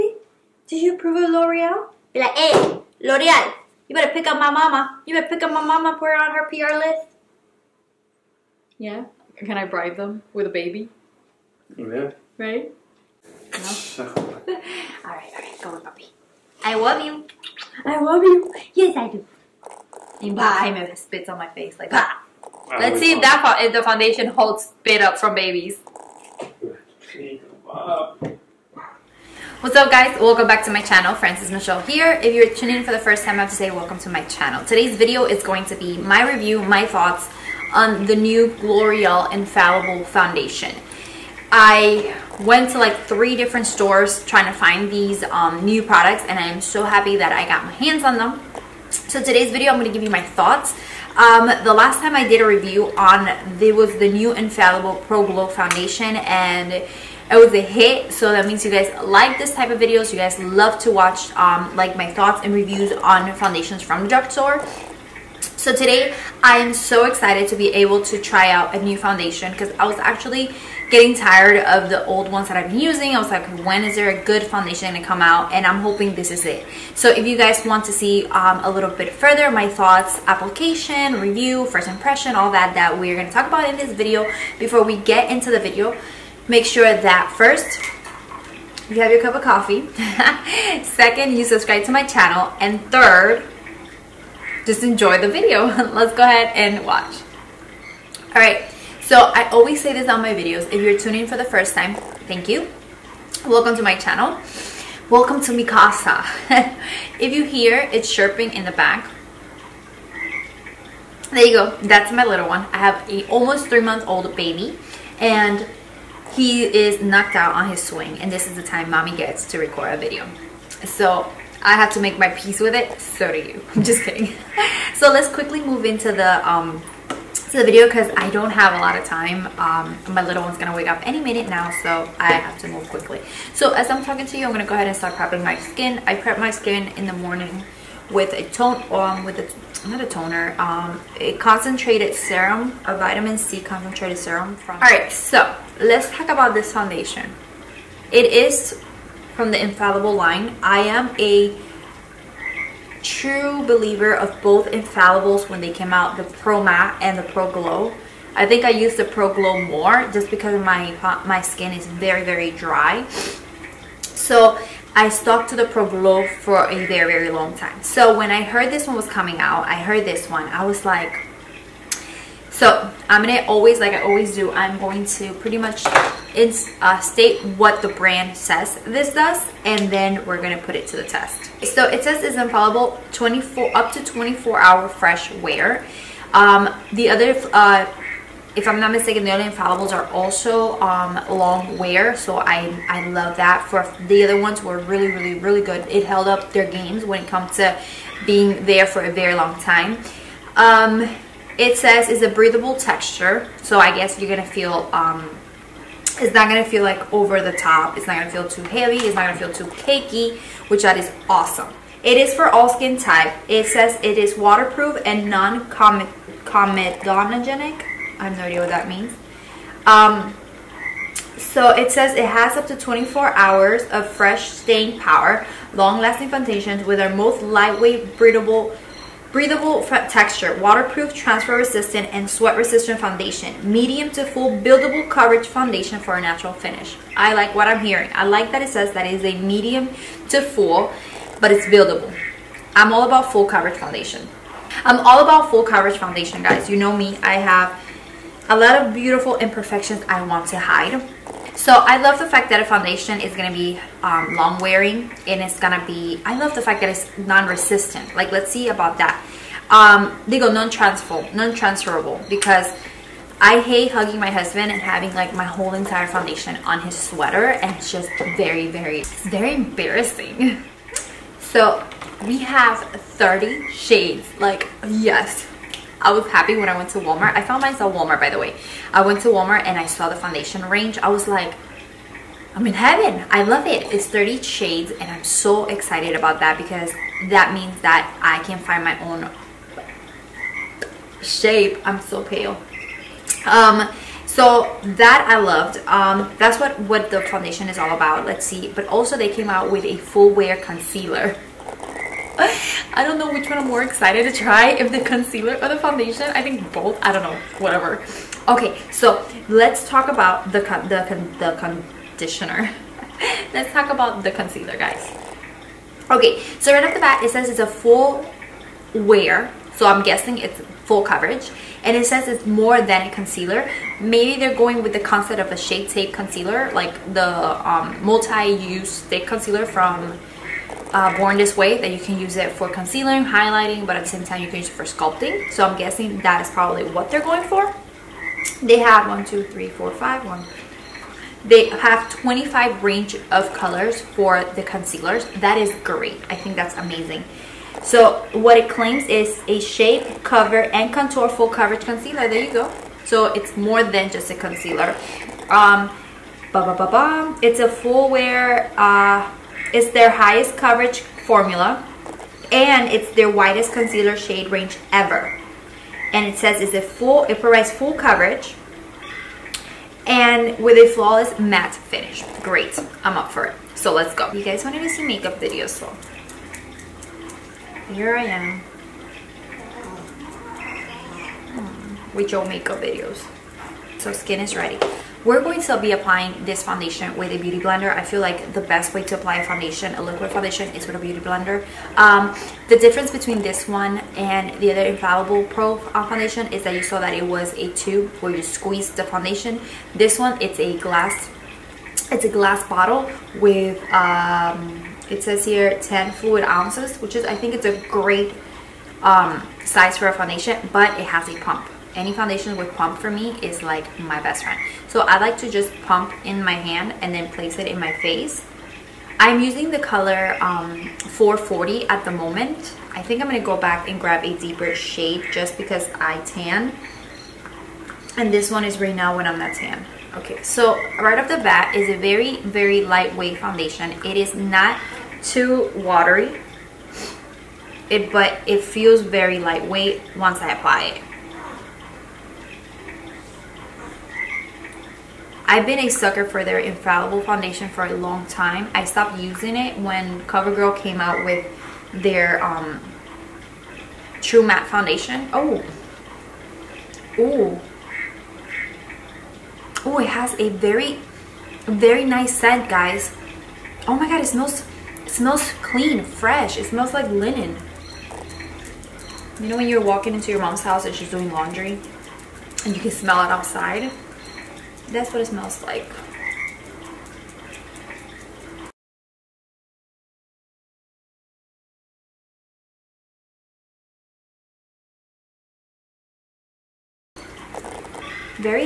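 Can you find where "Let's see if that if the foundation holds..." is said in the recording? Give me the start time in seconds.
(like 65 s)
22 s.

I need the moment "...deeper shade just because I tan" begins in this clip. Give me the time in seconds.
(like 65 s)
424 s.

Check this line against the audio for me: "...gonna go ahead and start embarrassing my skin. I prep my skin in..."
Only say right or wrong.
wrong.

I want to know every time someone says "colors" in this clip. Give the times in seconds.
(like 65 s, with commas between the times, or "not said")
343 s, 419 s.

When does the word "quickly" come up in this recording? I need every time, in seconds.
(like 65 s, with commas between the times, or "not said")
125 s, 132 s.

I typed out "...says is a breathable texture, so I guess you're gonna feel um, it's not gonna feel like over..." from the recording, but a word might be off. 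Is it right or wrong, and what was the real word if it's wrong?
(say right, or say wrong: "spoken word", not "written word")
right.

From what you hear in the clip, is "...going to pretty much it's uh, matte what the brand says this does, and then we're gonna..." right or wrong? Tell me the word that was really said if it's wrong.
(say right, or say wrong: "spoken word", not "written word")
wrong: "state", not "matte".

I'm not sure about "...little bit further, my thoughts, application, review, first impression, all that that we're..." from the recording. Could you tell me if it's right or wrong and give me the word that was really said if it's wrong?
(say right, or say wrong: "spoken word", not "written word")
right.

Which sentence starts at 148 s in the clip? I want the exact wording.
It is from the infallible line.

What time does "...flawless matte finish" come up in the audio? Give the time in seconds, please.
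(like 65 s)
370 s.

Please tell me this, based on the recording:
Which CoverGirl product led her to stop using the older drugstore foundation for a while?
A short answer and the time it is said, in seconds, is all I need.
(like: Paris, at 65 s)
True Matte Foundation, at 454 s.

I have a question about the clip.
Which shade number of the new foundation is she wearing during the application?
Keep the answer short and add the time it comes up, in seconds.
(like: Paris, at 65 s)
440, at 420 s.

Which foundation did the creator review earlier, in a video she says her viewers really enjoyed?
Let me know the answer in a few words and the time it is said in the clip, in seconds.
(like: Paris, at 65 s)
Infallible Pro Glow, at 54 s.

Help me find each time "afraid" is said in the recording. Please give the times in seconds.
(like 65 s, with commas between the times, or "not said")
not said.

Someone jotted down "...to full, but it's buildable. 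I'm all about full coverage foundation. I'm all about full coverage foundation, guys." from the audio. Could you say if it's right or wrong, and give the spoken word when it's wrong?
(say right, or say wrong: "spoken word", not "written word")
right.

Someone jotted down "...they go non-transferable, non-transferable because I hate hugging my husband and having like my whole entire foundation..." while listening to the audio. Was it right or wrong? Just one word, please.
right.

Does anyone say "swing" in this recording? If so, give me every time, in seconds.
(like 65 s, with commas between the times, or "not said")
117 s.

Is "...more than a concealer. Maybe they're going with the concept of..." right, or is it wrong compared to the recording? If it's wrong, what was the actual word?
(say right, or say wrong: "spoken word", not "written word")
right.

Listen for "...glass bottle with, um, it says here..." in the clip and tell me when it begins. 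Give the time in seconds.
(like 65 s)
402 s.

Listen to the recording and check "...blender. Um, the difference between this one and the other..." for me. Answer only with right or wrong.
right.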